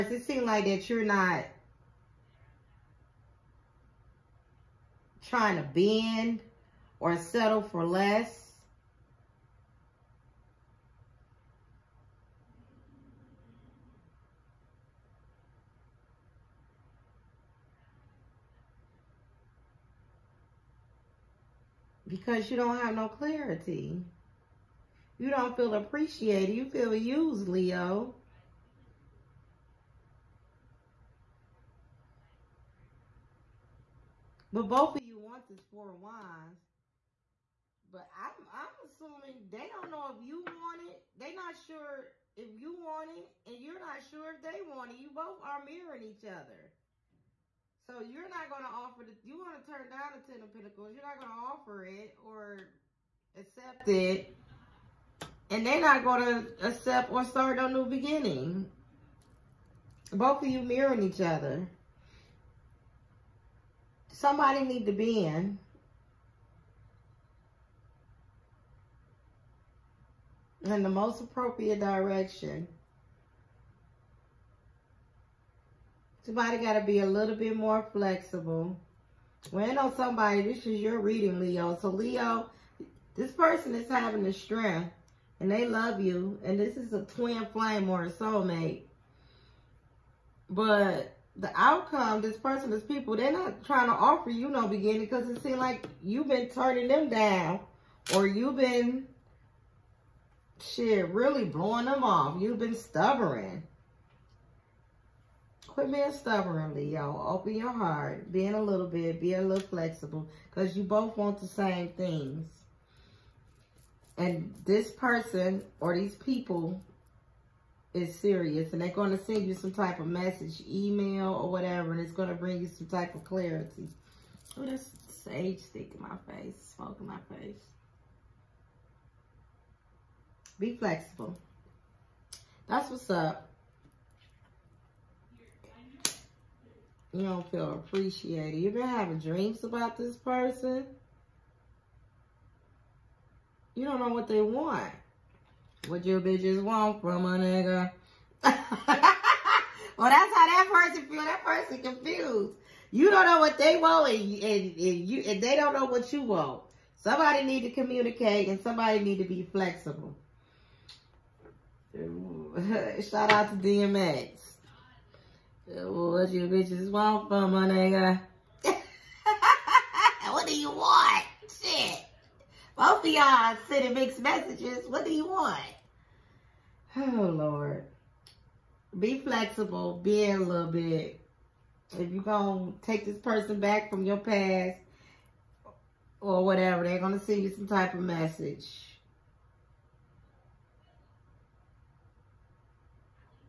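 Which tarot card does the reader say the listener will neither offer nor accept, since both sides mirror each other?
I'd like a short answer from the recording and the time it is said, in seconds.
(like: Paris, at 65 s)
Ten of Pentacles, at 50 s.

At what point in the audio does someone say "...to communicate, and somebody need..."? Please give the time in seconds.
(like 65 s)
157 s.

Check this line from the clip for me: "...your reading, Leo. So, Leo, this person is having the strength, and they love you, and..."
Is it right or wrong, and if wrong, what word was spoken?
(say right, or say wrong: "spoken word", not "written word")
right.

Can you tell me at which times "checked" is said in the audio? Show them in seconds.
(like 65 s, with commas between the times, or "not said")
not said.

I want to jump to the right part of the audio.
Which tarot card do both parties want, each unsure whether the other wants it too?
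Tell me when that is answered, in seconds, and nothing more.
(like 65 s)
35 s.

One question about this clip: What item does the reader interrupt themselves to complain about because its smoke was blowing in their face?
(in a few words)
Sage stick.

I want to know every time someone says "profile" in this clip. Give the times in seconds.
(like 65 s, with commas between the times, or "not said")
not said.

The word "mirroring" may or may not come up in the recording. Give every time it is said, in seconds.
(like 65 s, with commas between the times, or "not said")
45 s, 60 s.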